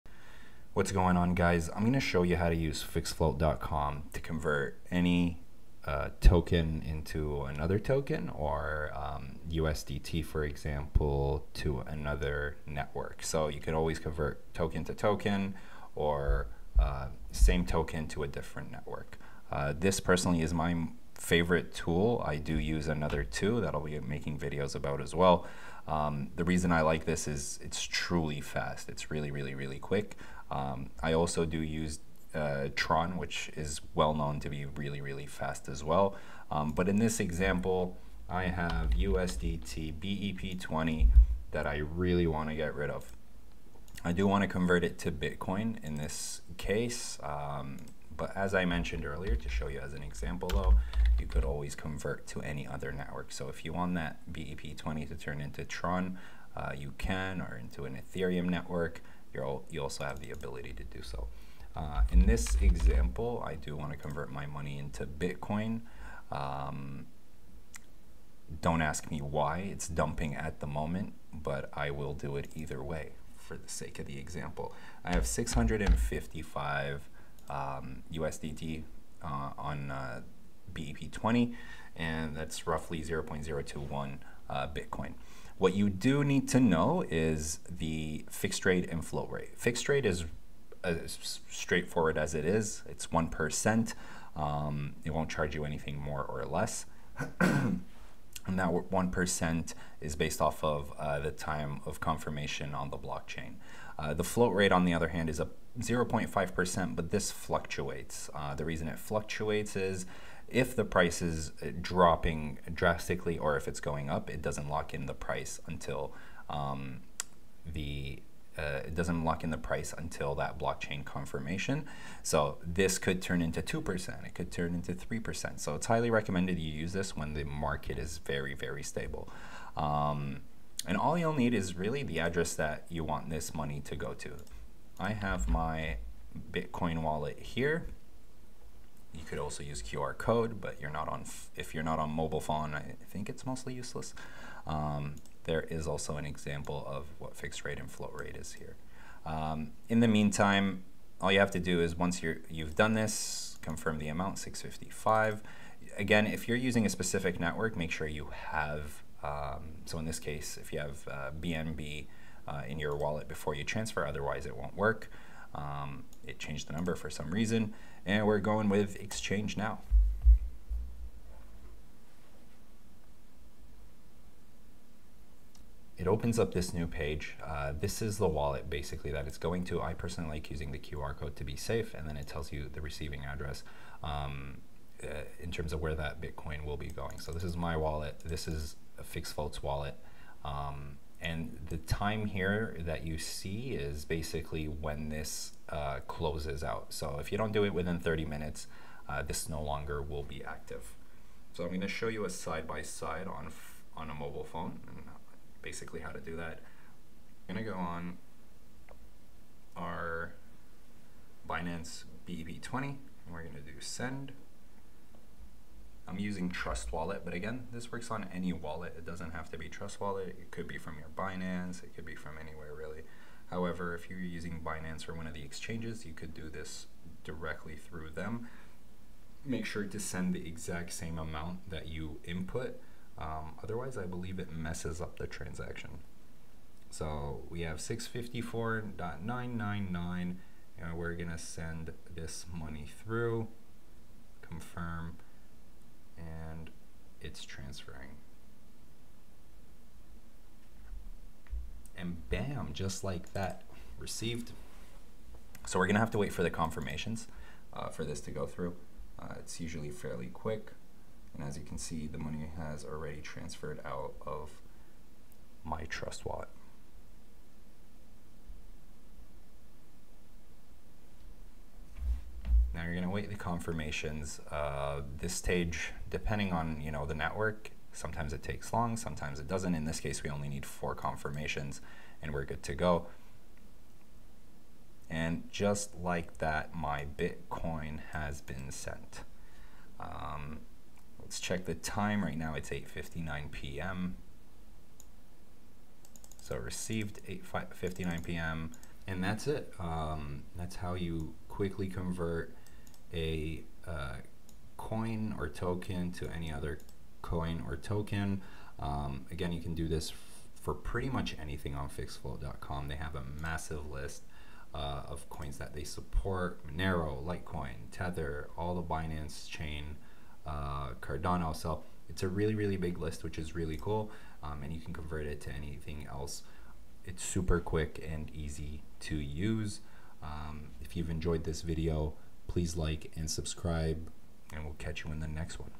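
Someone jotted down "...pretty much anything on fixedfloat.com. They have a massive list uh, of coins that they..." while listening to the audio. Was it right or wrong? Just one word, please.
right.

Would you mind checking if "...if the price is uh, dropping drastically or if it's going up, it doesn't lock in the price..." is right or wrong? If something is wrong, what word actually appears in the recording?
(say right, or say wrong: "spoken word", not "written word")
right.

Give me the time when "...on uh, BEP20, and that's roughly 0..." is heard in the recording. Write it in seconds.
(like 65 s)
79 s.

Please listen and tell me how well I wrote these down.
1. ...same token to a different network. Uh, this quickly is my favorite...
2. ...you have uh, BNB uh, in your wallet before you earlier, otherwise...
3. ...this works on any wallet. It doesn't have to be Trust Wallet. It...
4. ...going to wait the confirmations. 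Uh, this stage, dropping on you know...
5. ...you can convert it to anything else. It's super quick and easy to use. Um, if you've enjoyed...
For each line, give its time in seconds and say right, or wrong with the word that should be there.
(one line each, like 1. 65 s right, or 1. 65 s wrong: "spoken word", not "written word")
1. 17 s wrong: "personally", not "quickly"
2. 160 s wrong: "transfer", not "earlier"
3. 217 s right
4. 272 s wrong: "depending", not "dropping"
5. 324 s right.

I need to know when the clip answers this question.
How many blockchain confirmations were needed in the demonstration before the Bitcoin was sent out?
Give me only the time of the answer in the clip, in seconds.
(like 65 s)
280 s.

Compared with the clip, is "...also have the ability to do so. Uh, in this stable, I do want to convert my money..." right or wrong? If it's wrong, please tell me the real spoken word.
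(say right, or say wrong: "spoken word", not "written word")
wrong: "example", not "stable".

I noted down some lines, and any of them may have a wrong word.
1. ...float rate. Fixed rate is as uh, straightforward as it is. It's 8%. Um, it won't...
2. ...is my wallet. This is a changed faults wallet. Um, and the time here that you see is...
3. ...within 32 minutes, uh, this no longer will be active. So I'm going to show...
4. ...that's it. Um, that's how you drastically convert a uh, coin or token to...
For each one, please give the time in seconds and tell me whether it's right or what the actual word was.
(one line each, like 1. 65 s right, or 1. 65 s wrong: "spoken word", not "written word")
1. 89 s wrong: "1", not "8"
2. 187 s wrong: "fixed", not "changed"
3. 197 s wrong: "30", not "32"
4. 299 s wrong: "quickly", not "drastically".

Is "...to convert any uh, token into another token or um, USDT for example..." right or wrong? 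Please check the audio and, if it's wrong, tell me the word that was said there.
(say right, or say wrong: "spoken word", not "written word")
right.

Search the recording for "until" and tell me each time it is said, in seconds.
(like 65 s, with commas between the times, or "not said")
115 s, 119 s.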